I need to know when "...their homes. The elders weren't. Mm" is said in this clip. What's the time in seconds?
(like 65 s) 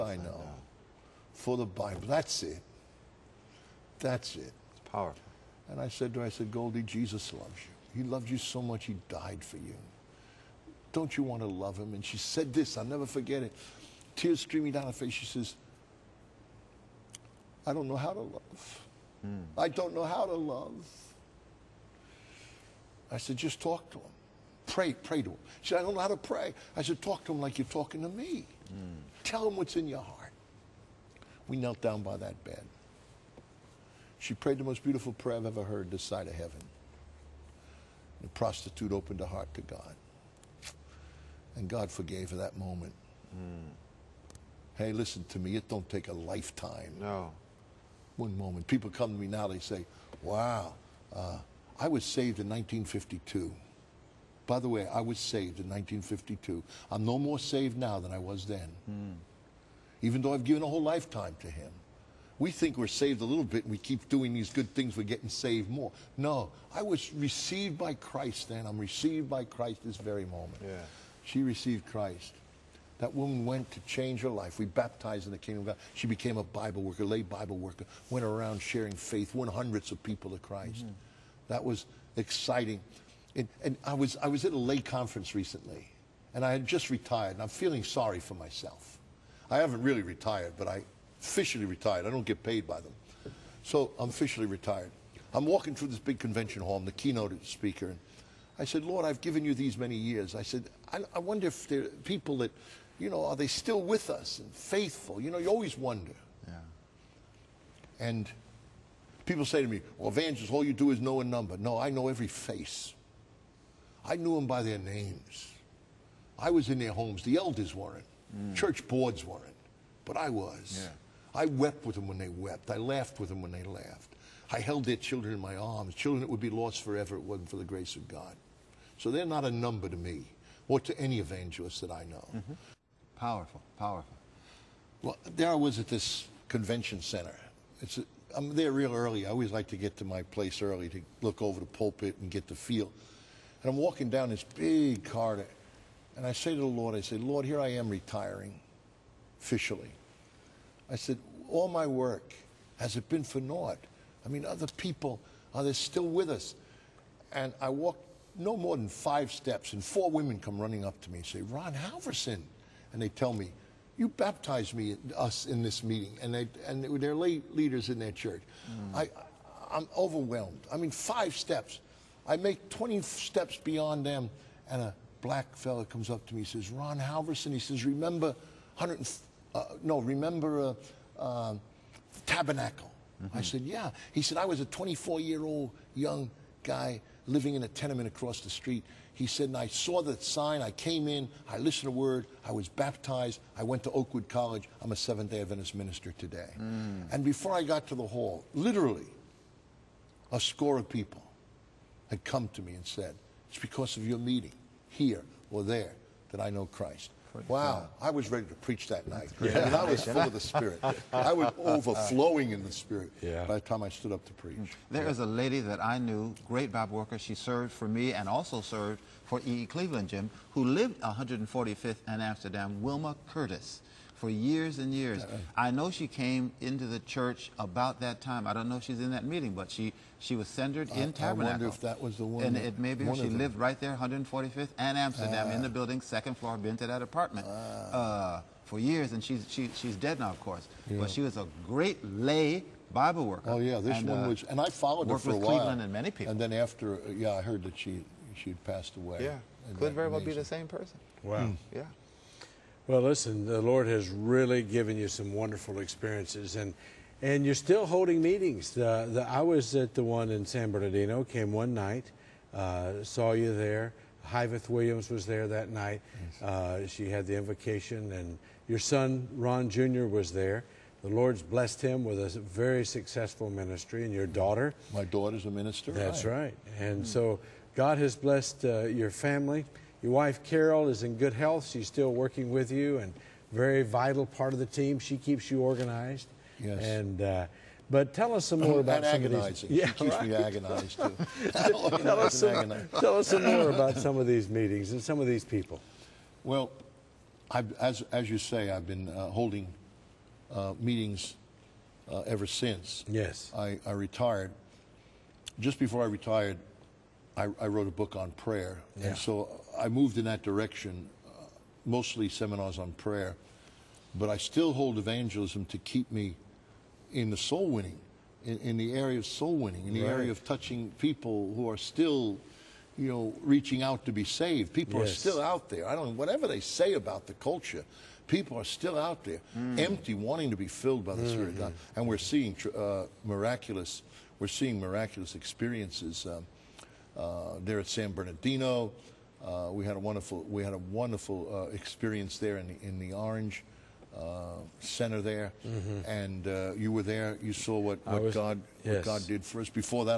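116 s.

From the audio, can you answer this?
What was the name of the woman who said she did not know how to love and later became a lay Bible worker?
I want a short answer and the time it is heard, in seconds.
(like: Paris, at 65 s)
Goldie, at 6 s.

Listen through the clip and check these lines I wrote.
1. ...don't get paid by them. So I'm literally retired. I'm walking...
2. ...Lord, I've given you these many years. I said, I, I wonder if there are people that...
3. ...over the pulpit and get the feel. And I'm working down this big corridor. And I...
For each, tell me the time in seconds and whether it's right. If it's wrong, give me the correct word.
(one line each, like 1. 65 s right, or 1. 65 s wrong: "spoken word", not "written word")
1. 92 s wrong: "officially", not "literally"
2. 98 s right
3. 141 s wrong: "walking", not "working".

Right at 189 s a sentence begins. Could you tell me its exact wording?
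He said, and I saw the sign.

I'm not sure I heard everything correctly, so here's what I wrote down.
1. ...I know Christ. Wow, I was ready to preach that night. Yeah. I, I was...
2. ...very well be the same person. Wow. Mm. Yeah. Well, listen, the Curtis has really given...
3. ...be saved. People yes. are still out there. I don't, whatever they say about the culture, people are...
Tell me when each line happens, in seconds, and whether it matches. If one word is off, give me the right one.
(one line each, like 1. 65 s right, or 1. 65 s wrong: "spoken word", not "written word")
1. 206 s right
2. 249 s wrong: "Lord", not "Curtis"
3. 324 s right.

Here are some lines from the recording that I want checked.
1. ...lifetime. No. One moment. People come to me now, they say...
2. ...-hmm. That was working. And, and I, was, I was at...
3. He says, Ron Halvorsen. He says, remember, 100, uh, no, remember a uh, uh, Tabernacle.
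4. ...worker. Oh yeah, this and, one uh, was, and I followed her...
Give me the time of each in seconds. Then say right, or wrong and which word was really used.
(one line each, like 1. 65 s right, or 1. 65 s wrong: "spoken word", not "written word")
1. 46 s right
2. 80 s wrong: "exciting", not "working"
3. 176 s right
4. 243 s right.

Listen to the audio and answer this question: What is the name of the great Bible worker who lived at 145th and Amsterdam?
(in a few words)
Wilma Curtis.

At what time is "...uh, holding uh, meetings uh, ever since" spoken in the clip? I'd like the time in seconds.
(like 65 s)
299 s.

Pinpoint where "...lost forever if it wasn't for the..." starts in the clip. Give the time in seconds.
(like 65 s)
126 s.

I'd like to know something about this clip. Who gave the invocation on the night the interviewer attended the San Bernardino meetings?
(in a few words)
Hyveth Williams.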